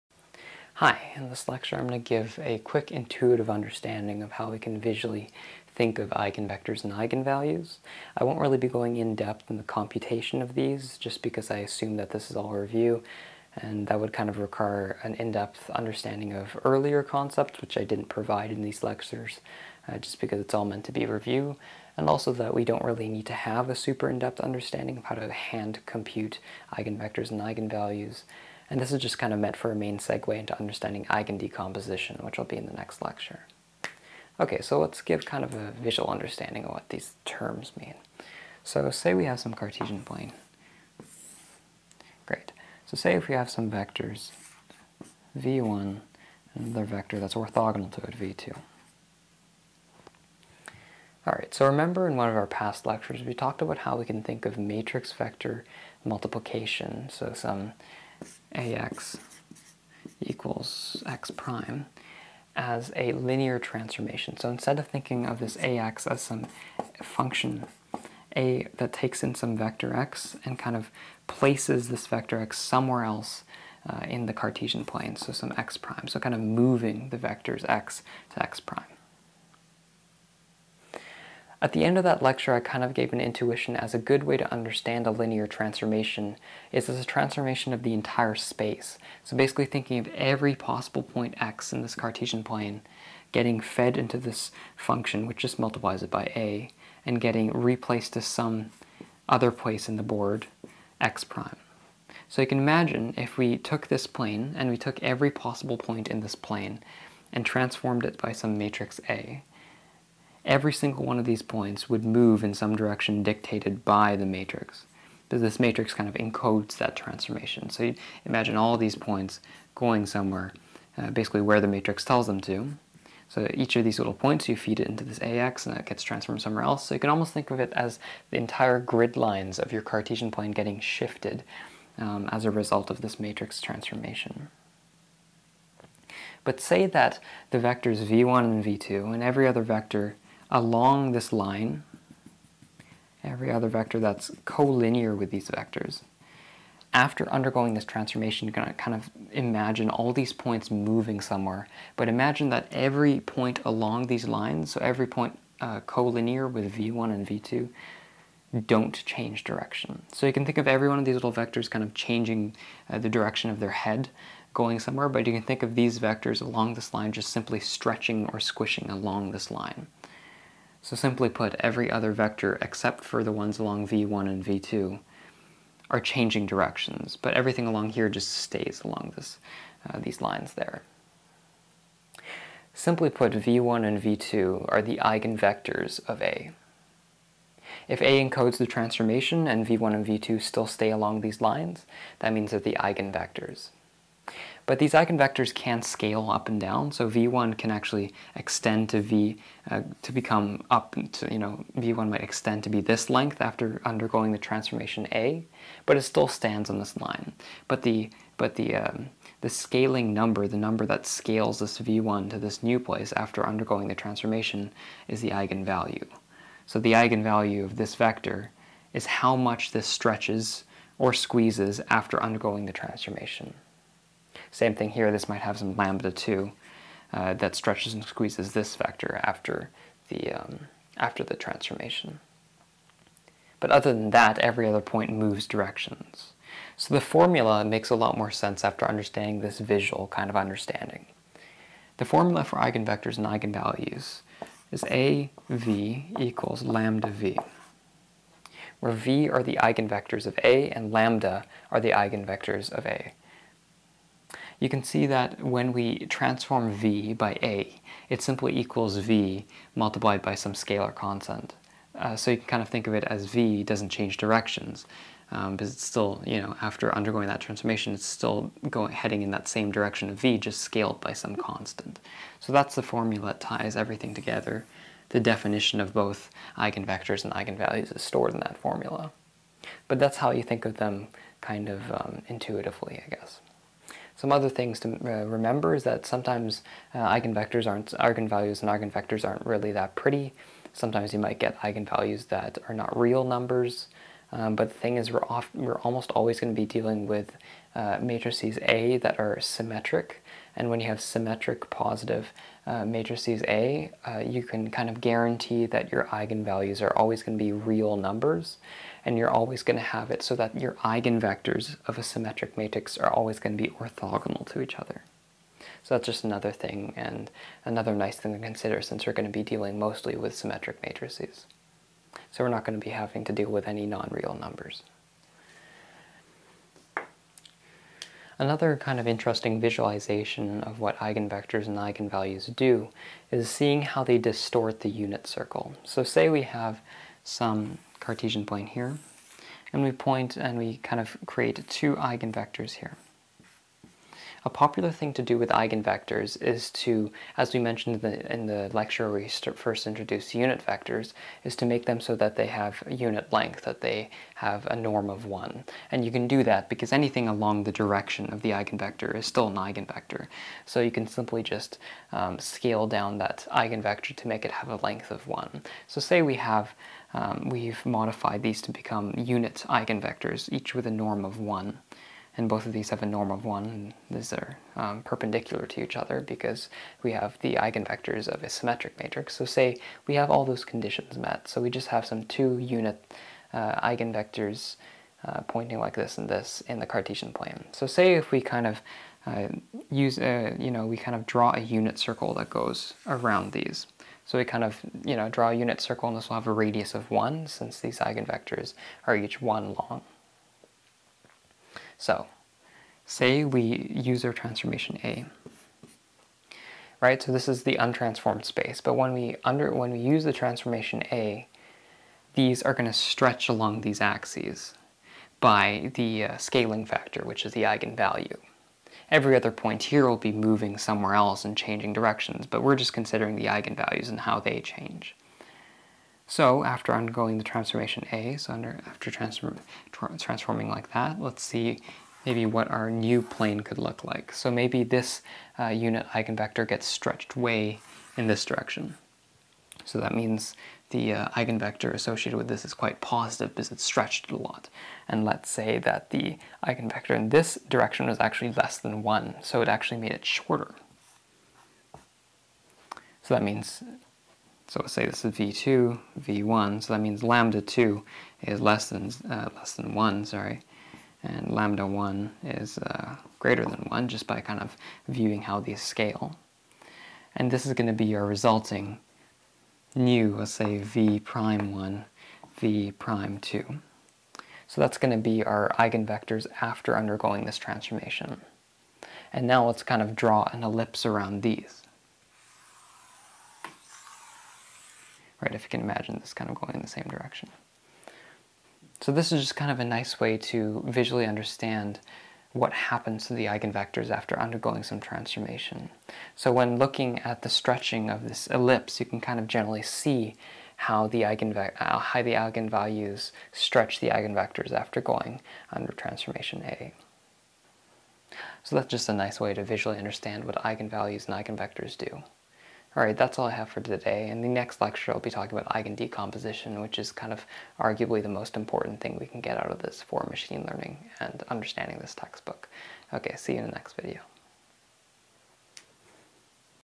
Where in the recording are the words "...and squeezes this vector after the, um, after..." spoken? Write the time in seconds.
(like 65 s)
227 s.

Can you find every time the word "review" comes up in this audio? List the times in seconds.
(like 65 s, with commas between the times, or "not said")
12 s, 21 s.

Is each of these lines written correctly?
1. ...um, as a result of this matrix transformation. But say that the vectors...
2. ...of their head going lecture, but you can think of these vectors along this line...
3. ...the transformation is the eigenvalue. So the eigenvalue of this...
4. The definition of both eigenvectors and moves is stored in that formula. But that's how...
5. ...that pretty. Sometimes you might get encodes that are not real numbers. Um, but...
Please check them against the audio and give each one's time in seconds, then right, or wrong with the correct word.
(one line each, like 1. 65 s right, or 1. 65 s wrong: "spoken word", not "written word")
1. 131 s right
2. 163 s wrong: "somewhere", not "lecture"
3. 213 s right
4. 275 s wrong: "eigenvalues", not "moves"
5. 289 s wrong: "eigenvalues", not "encodes".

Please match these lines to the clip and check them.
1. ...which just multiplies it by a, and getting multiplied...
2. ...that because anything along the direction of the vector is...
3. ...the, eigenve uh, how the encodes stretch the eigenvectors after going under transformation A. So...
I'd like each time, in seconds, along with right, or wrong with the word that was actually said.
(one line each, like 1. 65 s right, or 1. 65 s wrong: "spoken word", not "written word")
1. 95 s wrong: "replaced", not "multiplied"
2. 356 s wrong: "eigenvector", not "vector"
3. 501 s wrong: "eigenvalues", not "encodes".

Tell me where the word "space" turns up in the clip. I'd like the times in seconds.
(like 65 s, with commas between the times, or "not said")
88 s, 408 s.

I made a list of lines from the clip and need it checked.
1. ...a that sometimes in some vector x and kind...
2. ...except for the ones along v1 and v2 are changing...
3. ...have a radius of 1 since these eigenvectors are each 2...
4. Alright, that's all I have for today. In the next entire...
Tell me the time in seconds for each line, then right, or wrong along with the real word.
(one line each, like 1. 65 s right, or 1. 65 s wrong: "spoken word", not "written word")
1. 68 s wrong: "takes", not "sometimes"
2. 172 s right
3. 396 s wrong: "1", not "2"
4. 512 s wrong: "lecture", not "entire".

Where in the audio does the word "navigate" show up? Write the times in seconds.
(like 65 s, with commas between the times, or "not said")
not said.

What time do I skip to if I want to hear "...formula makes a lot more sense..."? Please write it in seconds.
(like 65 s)
237 s.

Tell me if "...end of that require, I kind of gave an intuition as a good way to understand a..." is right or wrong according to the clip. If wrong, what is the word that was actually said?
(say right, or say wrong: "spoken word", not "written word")
wrong: "lecture", not "require".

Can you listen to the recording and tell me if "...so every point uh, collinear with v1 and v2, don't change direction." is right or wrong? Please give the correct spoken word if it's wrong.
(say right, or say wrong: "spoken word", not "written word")
right.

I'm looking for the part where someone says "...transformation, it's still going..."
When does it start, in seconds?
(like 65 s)
267 s.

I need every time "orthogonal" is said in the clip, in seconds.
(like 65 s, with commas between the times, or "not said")
47 s, 313 s.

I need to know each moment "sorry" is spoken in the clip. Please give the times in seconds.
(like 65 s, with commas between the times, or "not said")
460 s.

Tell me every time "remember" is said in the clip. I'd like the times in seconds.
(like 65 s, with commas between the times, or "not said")
51 s, 285 s.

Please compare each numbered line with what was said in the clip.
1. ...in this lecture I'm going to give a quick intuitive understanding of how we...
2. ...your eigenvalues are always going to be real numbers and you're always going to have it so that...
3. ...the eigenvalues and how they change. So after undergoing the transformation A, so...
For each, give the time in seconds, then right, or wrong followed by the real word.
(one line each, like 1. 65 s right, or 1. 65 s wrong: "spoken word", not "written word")
1. 1 s right
2. 305 s right
3. 423 s right.